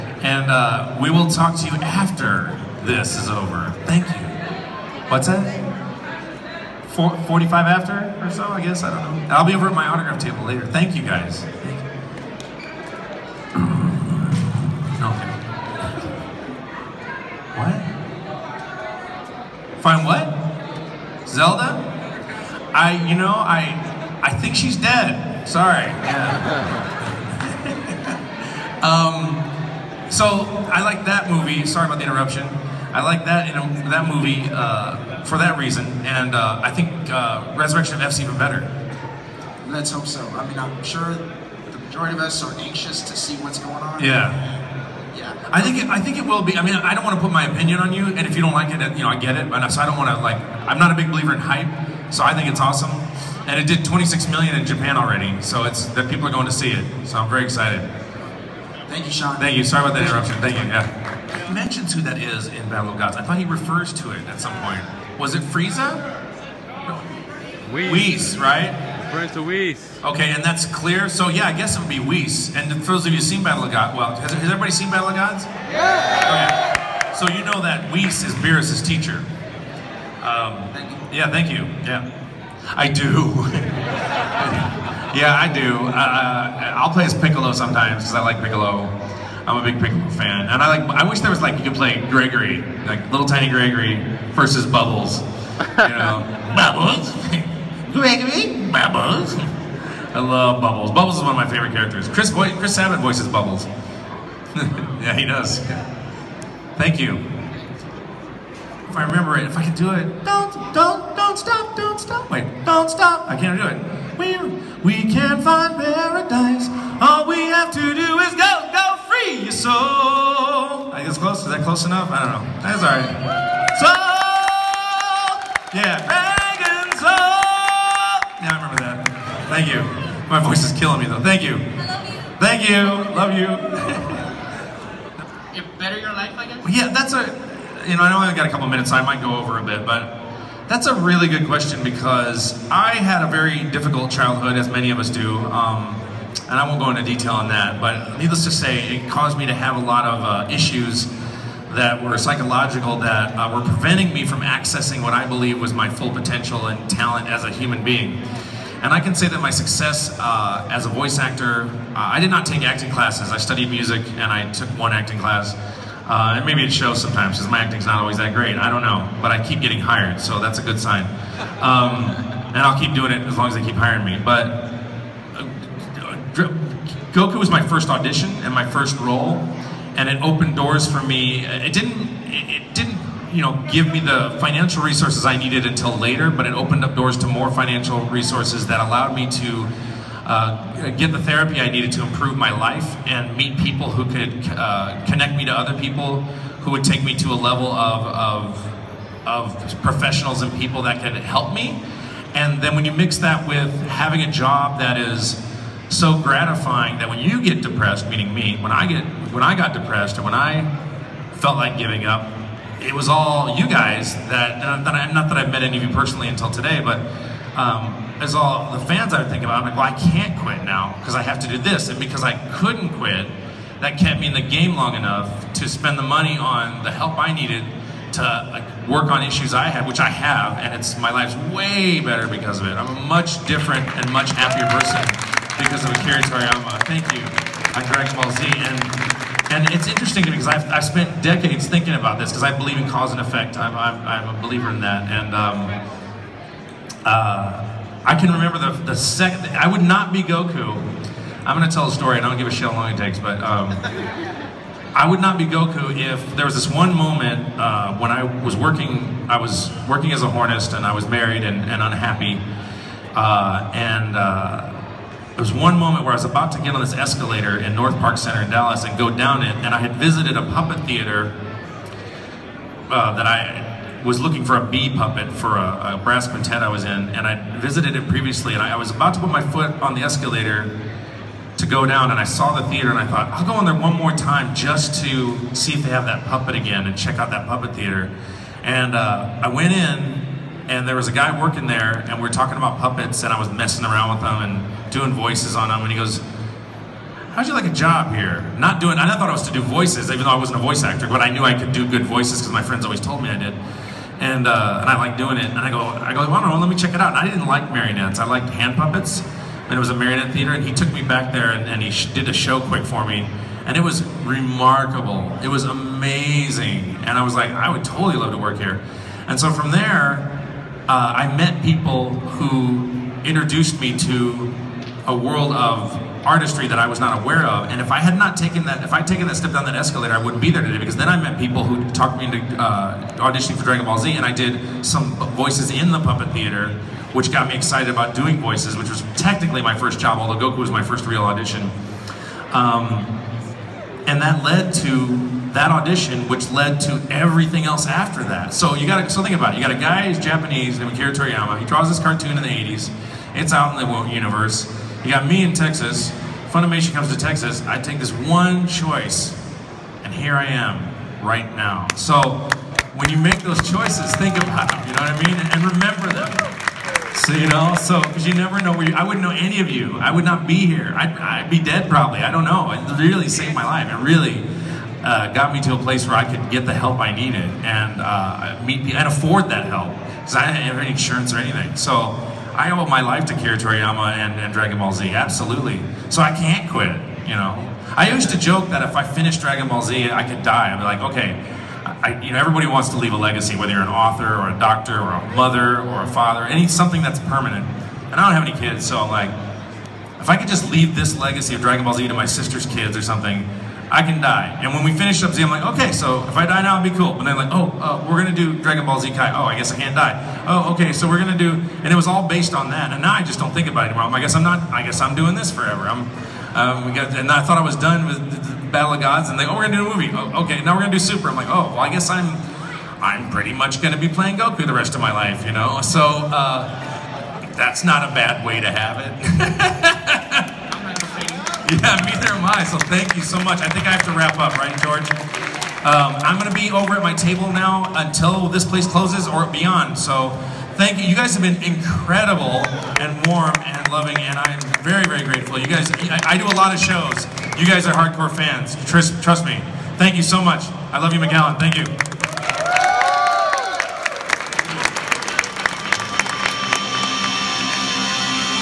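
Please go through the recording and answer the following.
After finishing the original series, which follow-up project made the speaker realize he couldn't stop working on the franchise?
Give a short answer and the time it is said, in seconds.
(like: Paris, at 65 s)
Dragon Ball Z Kai, at 408 s.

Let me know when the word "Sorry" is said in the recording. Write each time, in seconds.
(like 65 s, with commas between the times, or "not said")
25 s, 31 s, 59 s.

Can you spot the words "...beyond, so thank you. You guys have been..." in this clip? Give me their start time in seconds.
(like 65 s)
439 s.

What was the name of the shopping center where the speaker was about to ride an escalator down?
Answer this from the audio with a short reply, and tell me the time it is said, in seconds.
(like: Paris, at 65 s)
North Park Center, at 267 s.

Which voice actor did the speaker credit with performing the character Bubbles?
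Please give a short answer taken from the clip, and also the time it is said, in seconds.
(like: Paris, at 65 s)
Chris Sabat, at 102 s.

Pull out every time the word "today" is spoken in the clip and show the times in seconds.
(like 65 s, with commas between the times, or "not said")
216 s, 330 s.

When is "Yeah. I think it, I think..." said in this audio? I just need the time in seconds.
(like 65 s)
45 s.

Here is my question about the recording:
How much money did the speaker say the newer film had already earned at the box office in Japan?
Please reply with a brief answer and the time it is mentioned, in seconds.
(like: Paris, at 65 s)
26 million, at 53 s.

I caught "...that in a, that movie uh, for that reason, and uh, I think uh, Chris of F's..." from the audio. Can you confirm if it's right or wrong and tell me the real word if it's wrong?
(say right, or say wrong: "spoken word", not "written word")
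wrong: "Resurrection", not "Chris".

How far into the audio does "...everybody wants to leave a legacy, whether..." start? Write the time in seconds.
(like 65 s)
392 s.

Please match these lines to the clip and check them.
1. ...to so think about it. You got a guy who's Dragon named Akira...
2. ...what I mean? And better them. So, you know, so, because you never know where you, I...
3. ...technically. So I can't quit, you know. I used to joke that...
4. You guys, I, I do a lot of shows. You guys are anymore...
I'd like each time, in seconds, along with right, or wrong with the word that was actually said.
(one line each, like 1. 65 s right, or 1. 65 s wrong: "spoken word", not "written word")
1. 349 s wrong: "Japanese", not "Dragon"
2. 365 s wrong: "remember", not "better"
3. 385 s wrong: "absolutely", not "technically"
4. 445 s wrong: "hardcore", not "anymore".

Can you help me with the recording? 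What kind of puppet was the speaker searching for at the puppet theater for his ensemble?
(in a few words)
bee puppet.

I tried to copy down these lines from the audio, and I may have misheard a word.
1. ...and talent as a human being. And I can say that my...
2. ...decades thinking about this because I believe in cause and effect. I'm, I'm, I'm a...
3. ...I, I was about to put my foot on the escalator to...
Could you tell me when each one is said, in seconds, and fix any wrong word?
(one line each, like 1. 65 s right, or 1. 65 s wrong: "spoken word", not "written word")
1. 156 s right
2. 241 s right
3. 278 s right.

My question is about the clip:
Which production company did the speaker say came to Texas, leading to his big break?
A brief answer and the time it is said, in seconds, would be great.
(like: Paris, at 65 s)
Funimation, at 356 s.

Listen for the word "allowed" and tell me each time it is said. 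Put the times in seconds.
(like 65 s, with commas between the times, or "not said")
188 s.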